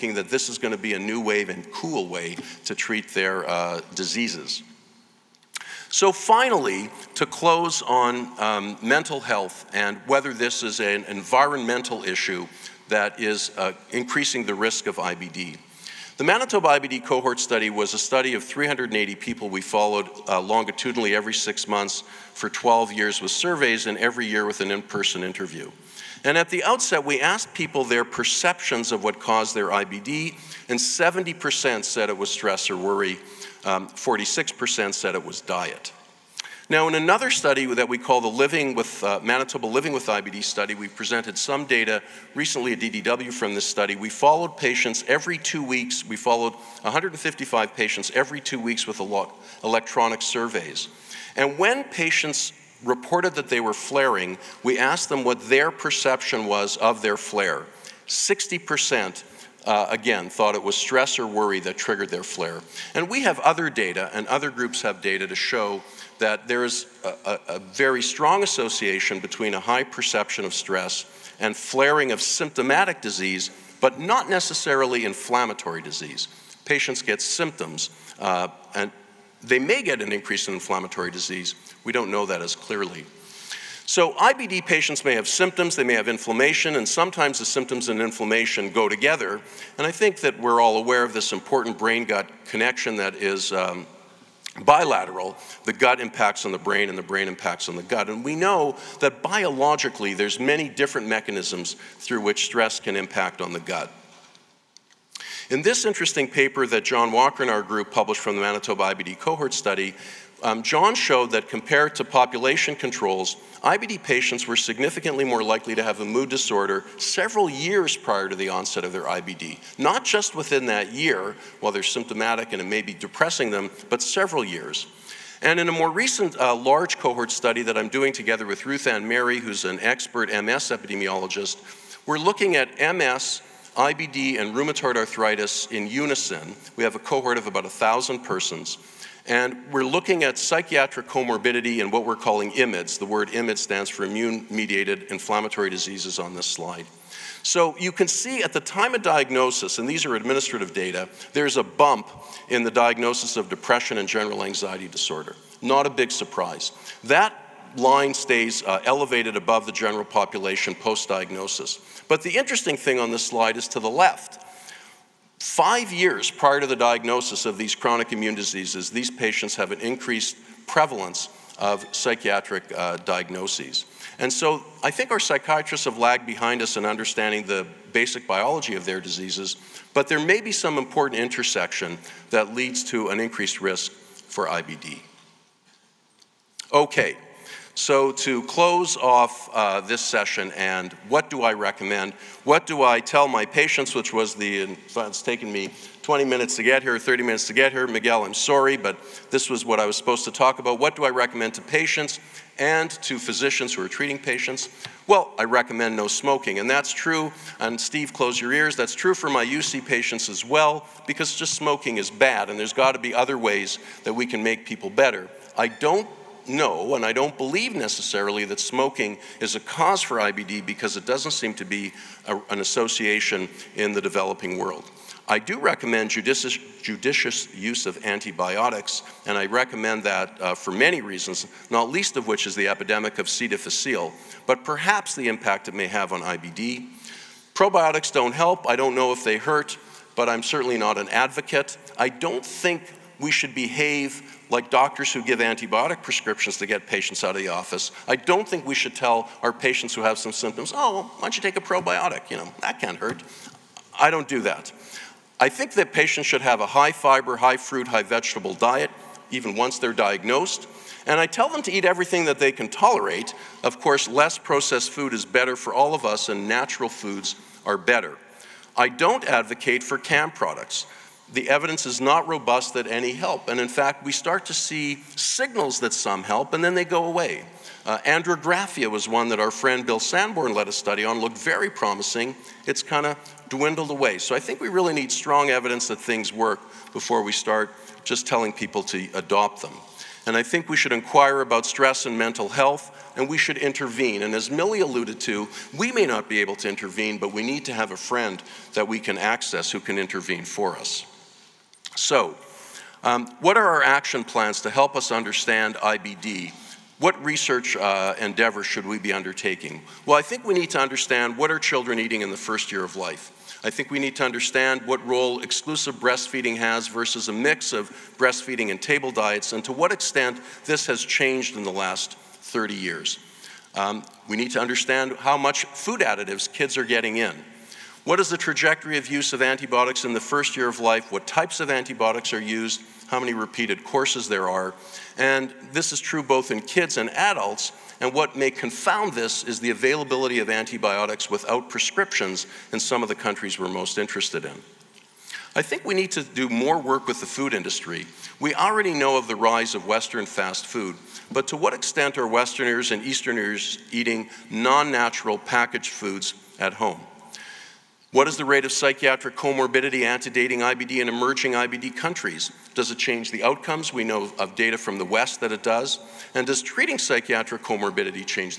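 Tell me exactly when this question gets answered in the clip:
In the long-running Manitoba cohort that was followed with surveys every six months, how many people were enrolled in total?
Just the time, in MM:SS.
00:18.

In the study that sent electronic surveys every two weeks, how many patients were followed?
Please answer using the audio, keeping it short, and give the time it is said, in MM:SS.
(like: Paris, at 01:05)
155, at 00:46.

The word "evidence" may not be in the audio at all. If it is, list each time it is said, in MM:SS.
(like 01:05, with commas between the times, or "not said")
04:31, 04:45.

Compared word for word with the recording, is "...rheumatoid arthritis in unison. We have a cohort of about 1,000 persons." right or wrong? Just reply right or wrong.
right.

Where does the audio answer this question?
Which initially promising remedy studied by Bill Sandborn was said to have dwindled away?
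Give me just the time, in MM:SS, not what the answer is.
04:37.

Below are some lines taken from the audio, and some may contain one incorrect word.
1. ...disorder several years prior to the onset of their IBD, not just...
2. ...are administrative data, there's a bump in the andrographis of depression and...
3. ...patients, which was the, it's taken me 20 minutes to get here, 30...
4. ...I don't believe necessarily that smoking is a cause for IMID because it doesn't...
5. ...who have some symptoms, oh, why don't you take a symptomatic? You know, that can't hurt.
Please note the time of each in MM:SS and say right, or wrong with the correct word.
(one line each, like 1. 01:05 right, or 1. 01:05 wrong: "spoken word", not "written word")
1. 01:56 right
2. 02:30 wrong: "diagnosis", not "andrographis"
3. 03:13 right
4. 03:37 wrong: "IBD", not "IMID"
5. 04:09 wrong: "probiotic", not "symptomatic".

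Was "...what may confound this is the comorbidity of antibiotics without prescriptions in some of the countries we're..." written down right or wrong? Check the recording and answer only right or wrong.
wrong.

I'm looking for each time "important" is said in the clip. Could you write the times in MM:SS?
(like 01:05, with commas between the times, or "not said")
01:31, 03:00.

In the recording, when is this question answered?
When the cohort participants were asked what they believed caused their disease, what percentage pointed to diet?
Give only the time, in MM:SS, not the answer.
00:33.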